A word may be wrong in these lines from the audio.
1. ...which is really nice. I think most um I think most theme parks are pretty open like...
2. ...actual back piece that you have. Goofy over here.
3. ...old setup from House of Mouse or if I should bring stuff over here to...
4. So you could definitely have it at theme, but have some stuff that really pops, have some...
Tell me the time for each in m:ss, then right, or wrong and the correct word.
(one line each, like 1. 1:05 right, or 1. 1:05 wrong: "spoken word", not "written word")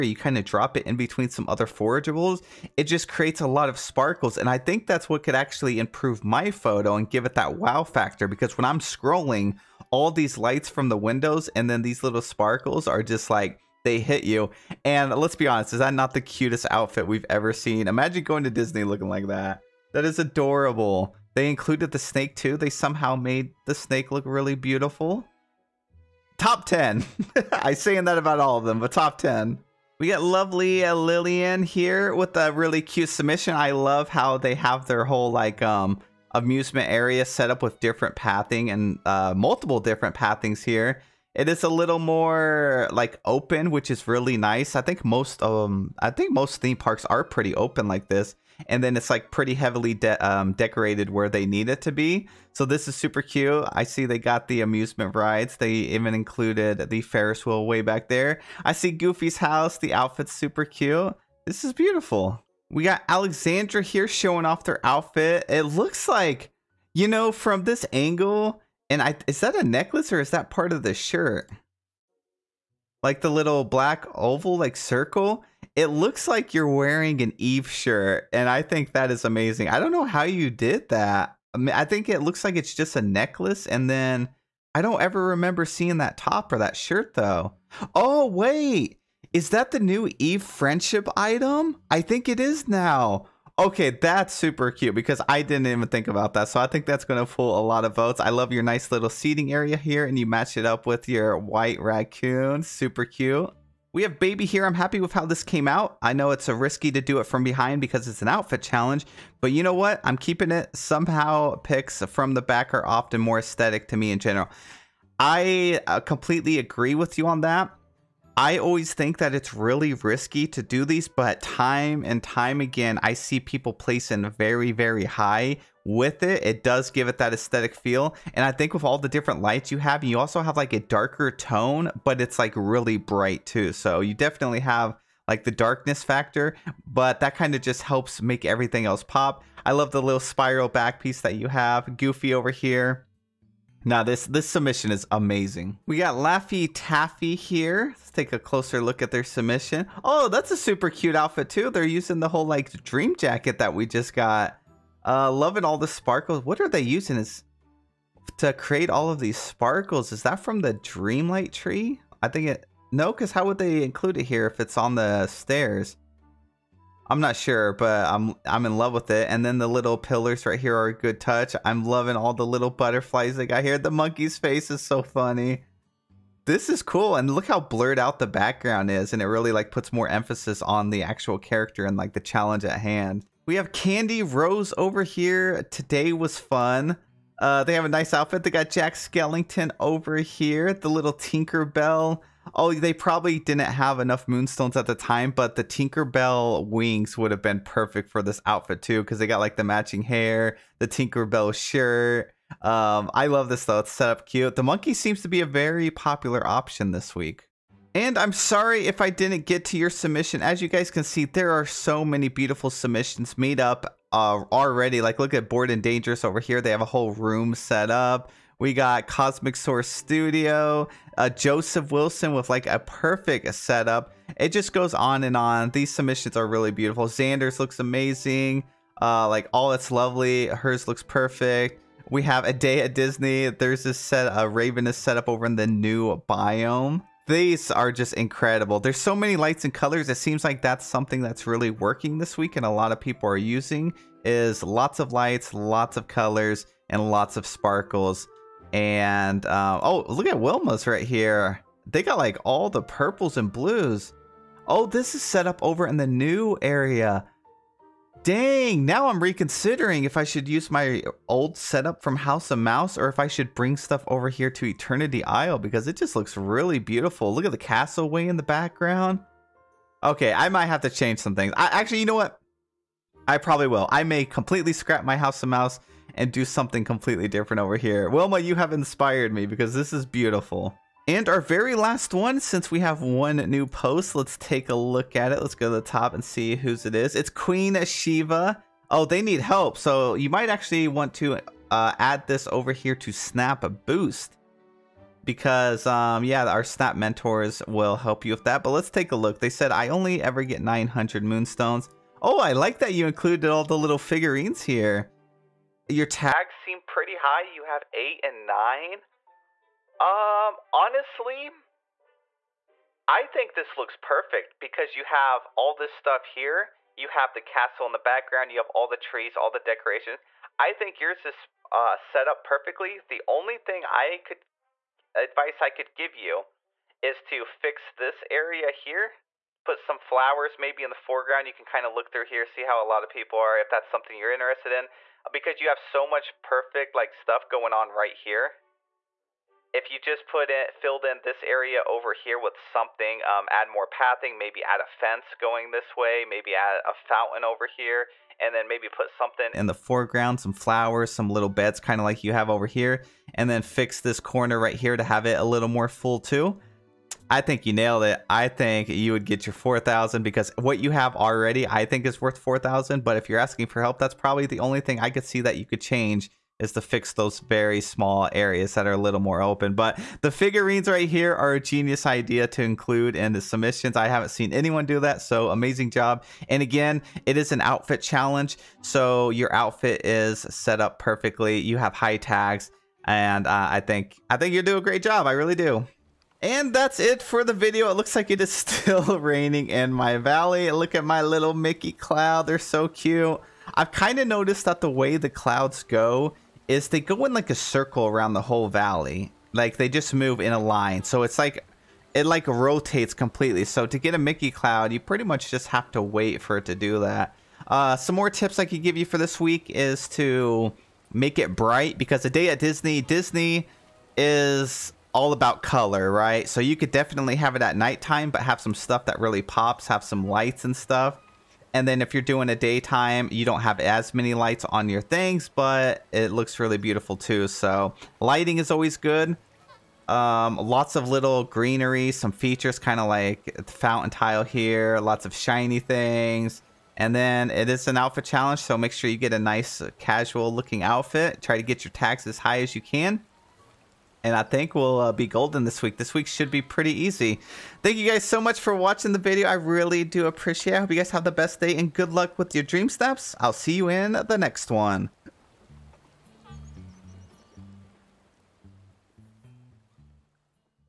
1. 0:43 right
2. 2:20 wrong: "spiral", not "actual"
3. 4:21 right
4. 6:56 wrong: "nighttime", not "theme".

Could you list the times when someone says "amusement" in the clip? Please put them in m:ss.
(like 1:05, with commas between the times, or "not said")
0:36, 0:54.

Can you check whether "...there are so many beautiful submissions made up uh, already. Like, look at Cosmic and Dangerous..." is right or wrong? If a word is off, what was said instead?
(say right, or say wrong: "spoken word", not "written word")
wrong: "Bored", not "Cosmic".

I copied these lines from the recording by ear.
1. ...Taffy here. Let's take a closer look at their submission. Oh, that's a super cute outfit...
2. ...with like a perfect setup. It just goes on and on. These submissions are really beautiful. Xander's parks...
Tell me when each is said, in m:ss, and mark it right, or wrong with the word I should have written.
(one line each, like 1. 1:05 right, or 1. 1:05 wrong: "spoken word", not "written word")
1. 2:26 right
2. 3:42 wrong: "looks", not "parks".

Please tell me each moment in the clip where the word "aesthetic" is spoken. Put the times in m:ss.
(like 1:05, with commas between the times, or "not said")
1:53, 2:07.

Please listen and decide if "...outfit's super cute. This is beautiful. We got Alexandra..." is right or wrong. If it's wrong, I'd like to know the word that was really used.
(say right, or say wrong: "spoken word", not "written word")
right.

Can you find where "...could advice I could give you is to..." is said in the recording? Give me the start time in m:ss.
5:24.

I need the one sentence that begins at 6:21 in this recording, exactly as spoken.
You have high tags, and uh, I think I think you do a great job.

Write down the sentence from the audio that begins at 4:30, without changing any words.
Okay, I might have to change some things.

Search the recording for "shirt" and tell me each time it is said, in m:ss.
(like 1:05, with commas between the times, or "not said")
1:10, 1:17, 1:26, 3:21.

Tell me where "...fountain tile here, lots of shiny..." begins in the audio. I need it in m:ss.
7:13.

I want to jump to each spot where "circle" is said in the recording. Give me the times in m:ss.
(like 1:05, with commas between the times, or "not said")
1:14, 6:37.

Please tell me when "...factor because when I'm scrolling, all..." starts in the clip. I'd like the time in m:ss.
0:07.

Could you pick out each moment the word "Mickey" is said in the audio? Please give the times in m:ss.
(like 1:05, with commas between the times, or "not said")
6:31, 6:44.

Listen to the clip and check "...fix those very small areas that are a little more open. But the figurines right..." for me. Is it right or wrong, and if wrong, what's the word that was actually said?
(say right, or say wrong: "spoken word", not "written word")
right.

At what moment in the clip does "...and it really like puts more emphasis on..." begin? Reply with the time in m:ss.
2:59.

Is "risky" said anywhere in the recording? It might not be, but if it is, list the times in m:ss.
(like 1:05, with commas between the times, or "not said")
1:46, 1:59.